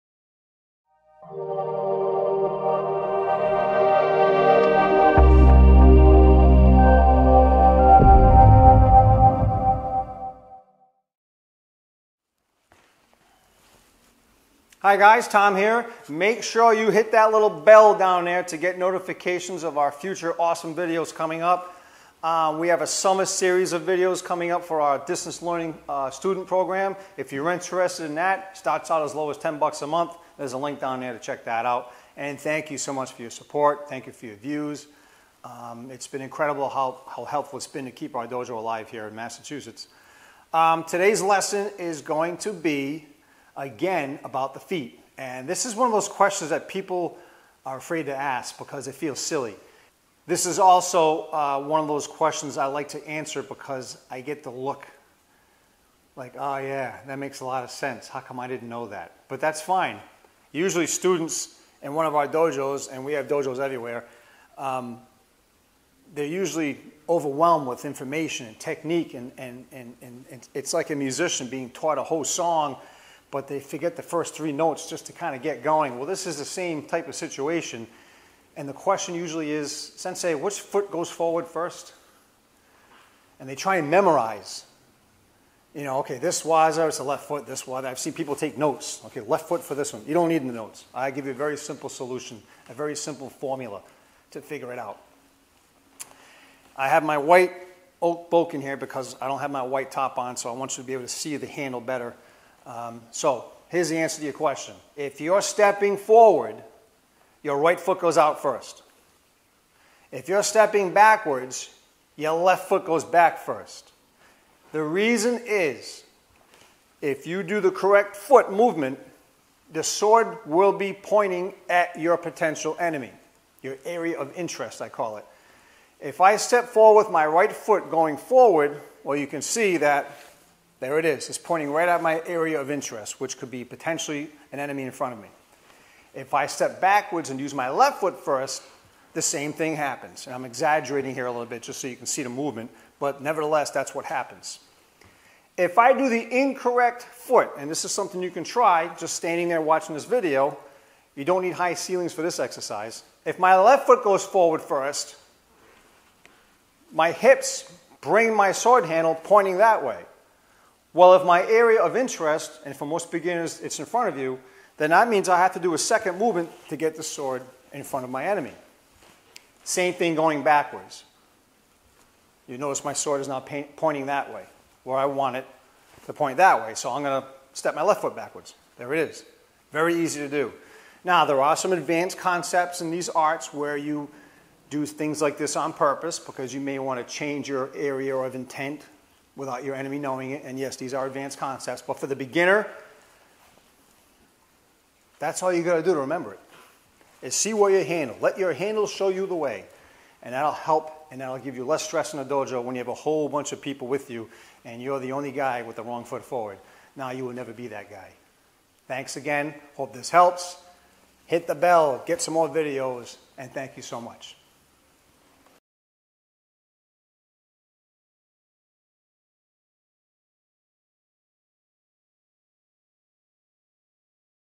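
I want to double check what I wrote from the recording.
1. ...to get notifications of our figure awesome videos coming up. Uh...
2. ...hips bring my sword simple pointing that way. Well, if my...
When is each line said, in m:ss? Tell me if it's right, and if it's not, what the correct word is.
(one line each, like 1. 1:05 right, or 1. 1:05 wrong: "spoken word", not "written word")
1. 0:18 wrong: "future", not "figure"
2. 2:37 wrong: "handle", not "simple".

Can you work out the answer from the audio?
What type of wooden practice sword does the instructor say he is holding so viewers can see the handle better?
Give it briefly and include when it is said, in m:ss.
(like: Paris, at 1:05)
white oak, at 1:37.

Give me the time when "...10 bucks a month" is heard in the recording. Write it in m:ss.
0:29.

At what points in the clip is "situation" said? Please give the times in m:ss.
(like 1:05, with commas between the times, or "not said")
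1:17.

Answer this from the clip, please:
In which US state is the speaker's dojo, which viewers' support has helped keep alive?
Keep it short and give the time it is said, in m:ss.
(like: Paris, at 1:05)
Massachusetts, at 0:39.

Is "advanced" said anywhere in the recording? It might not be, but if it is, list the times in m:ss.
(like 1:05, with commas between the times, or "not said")
3:01, 3:11.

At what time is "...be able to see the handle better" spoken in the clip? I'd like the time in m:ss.
1:40.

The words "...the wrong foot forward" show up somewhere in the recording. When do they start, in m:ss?
3:25.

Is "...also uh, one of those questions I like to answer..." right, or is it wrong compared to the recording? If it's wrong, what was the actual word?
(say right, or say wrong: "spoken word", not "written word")
right.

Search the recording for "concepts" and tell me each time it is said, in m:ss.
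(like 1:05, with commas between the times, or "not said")
3:02, 3:11.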